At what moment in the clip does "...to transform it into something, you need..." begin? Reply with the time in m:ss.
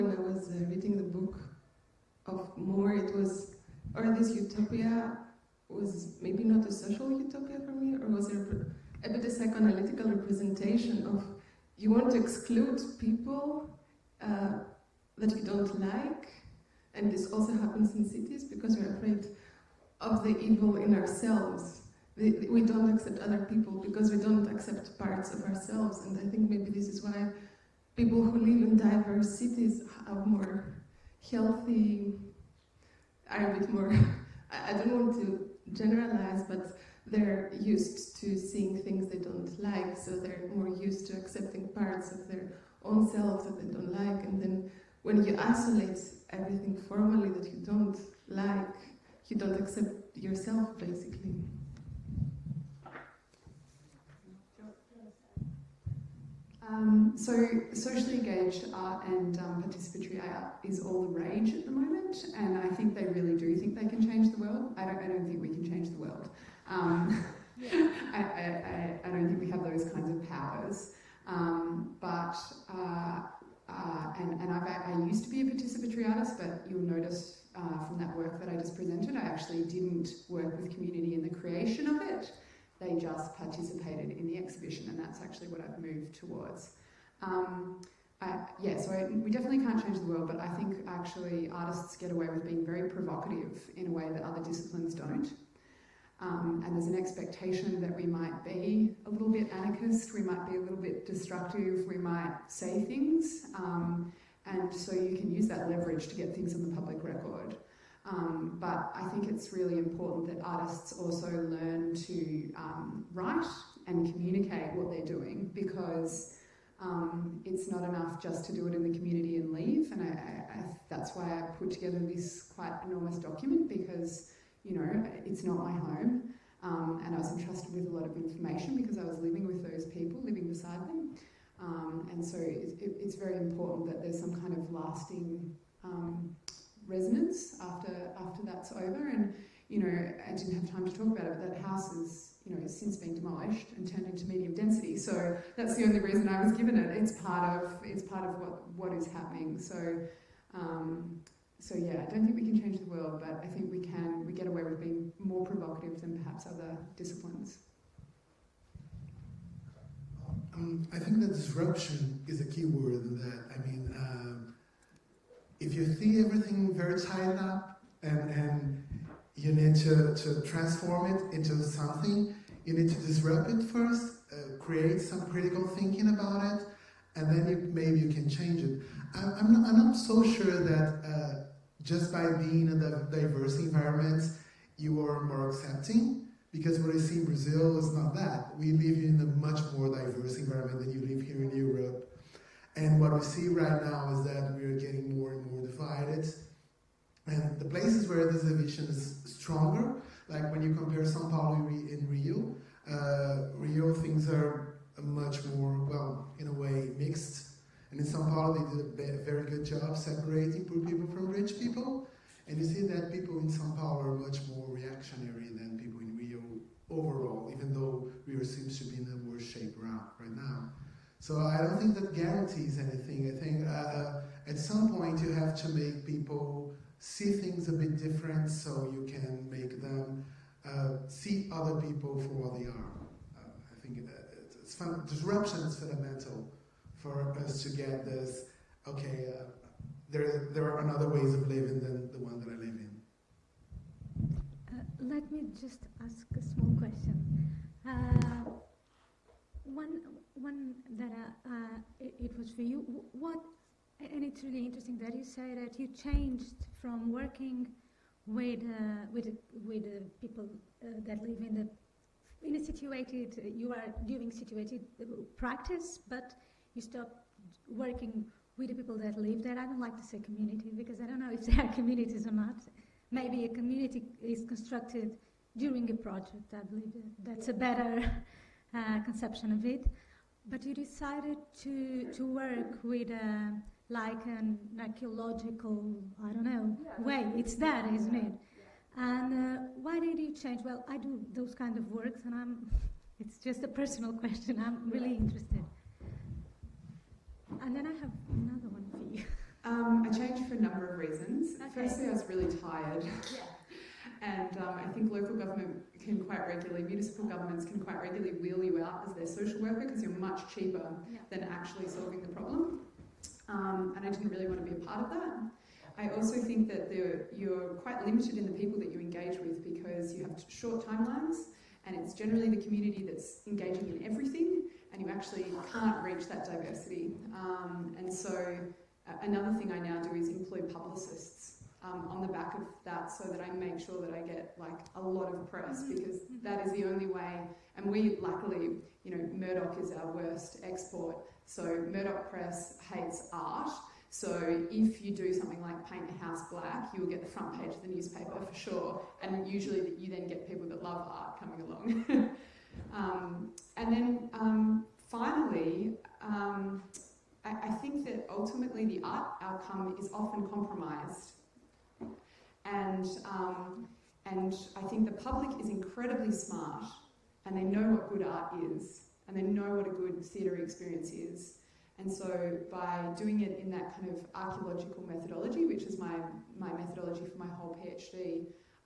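2:50.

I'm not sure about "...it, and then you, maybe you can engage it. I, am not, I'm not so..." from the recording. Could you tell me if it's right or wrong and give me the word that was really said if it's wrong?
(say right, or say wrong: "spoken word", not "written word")
wrong: "change", not "engage".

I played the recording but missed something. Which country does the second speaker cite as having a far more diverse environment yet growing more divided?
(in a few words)
Brazil.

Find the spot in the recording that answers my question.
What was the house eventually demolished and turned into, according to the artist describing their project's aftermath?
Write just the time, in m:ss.
2:24.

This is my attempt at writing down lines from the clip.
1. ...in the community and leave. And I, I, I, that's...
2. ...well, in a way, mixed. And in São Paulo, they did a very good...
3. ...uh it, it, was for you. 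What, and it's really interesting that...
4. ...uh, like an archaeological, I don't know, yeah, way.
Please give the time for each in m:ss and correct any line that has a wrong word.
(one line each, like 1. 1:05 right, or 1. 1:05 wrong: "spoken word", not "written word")
1. 1:58 right
2. 3:25 right
3. 4:11 right
4. 4:43 right.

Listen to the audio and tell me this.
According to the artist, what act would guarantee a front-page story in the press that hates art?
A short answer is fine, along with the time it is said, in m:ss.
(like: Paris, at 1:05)
paint a house black, at 5:45.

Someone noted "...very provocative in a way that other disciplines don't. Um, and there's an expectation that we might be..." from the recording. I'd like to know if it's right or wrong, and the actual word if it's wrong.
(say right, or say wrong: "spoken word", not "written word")
right.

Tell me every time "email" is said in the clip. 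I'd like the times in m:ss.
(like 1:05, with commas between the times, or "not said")
not said.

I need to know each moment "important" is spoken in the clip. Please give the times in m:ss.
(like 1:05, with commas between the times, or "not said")
1:49, 2:13.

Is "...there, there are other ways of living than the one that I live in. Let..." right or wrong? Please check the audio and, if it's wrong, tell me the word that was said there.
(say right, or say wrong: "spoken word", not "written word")
right.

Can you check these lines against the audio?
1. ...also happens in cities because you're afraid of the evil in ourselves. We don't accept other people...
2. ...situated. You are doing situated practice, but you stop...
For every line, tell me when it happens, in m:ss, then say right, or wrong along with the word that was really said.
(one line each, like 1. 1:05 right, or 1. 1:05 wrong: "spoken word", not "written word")
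1. 0:17 right
2. 4:22 right.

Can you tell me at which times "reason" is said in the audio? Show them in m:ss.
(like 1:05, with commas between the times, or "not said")
2:25, 5:00.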